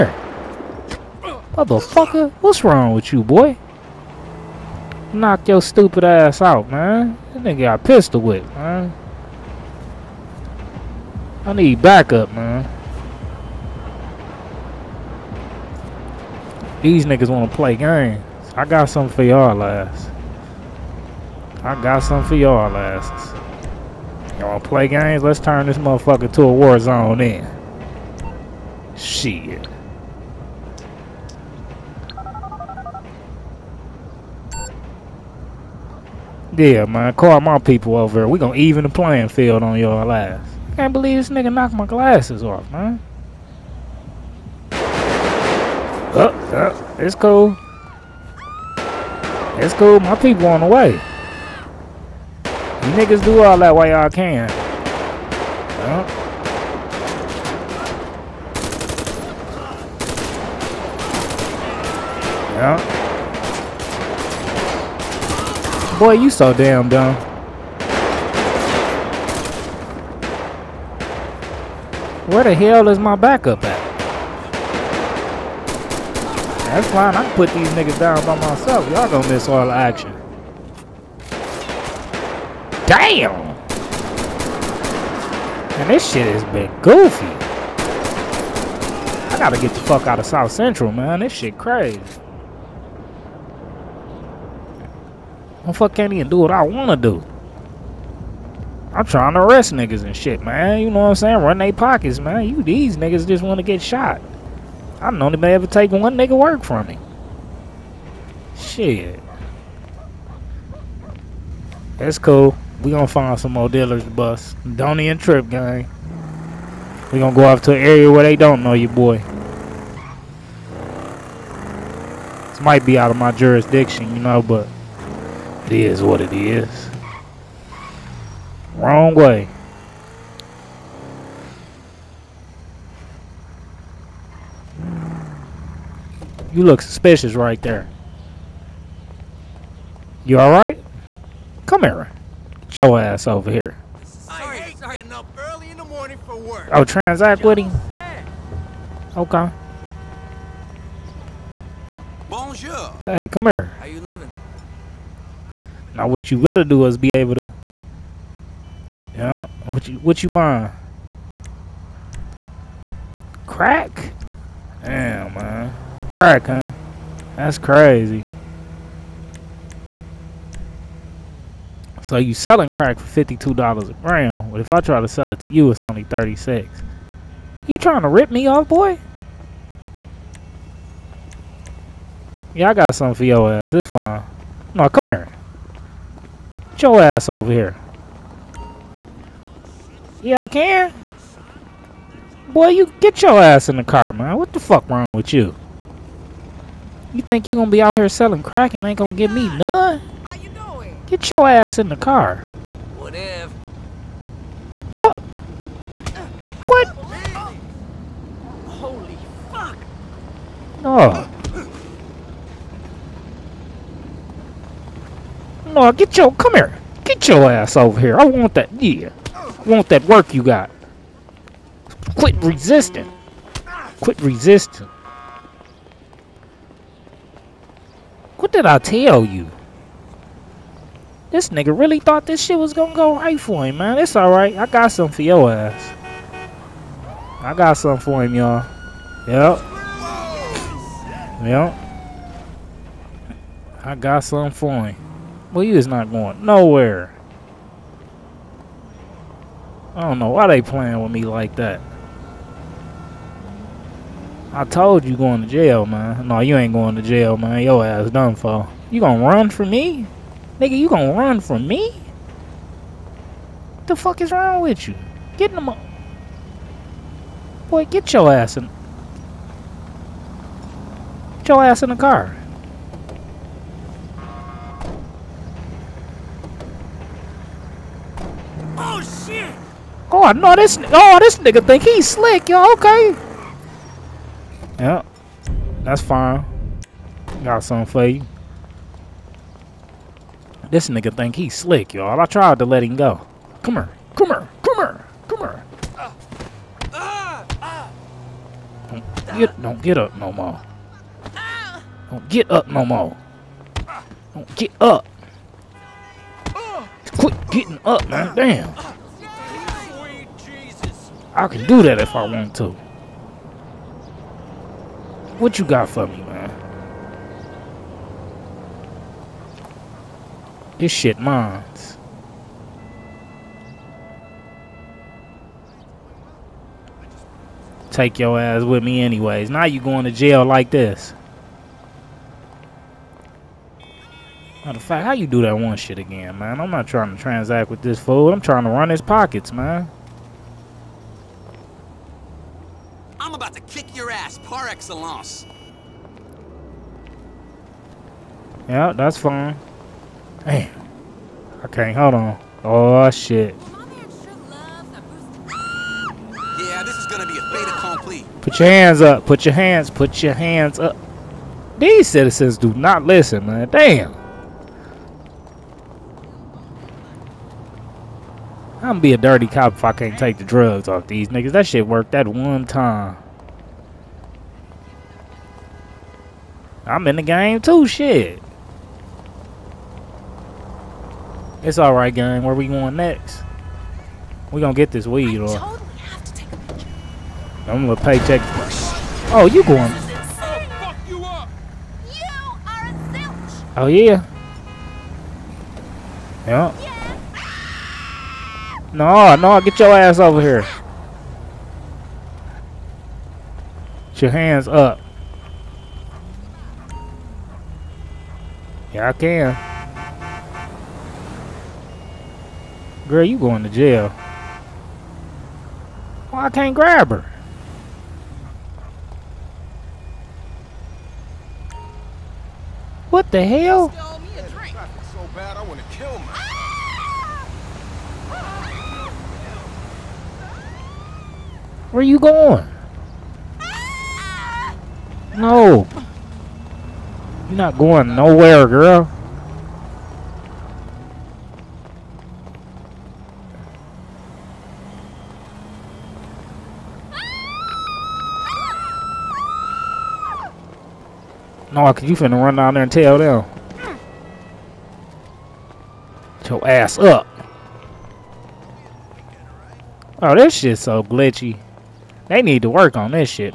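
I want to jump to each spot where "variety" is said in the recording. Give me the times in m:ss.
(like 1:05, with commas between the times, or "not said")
not said.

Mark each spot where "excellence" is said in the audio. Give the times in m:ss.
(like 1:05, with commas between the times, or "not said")
5:44.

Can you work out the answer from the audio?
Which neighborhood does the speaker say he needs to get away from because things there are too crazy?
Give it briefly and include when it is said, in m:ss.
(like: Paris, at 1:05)
South Central, at 1:30.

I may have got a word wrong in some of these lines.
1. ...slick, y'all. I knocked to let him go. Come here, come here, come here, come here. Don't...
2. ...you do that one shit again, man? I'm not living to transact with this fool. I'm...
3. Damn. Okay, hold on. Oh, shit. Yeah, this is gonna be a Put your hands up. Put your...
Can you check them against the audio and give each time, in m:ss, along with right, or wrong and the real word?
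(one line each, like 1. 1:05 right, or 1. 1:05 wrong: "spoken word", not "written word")
1. 4:51 wrong: "tried", not "knocked"
2. 5:35 wrong: "trying", not "living"
3. 5:50 right.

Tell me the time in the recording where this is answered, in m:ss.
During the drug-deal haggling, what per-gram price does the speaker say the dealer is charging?
2:53.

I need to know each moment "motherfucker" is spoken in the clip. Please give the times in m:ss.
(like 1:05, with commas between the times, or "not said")
0:01, 0:25.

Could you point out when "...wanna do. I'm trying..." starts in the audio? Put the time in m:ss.
1:36.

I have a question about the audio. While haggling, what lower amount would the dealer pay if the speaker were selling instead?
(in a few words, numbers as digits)
36.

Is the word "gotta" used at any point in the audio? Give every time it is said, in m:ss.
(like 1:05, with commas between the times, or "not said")
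1:29, 2:36.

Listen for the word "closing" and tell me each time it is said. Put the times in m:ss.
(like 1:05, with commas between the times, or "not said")
not said.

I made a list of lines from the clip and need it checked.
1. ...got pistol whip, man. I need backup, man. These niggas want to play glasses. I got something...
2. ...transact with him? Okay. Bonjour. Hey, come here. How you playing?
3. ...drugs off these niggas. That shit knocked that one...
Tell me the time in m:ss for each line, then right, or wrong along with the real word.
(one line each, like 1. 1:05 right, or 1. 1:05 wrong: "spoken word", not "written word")
1. 0:07 wrong: "games", not "glasses"
2. 2:26 wrong: "living", not "playing"
3. 6:10 wrong: "worked", not "knocked".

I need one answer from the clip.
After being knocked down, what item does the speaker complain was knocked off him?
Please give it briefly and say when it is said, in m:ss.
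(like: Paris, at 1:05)
glasses, at 0:41.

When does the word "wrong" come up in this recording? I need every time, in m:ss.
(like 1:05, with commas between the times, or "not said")
0:02, 2:08, 3:14, 4:24.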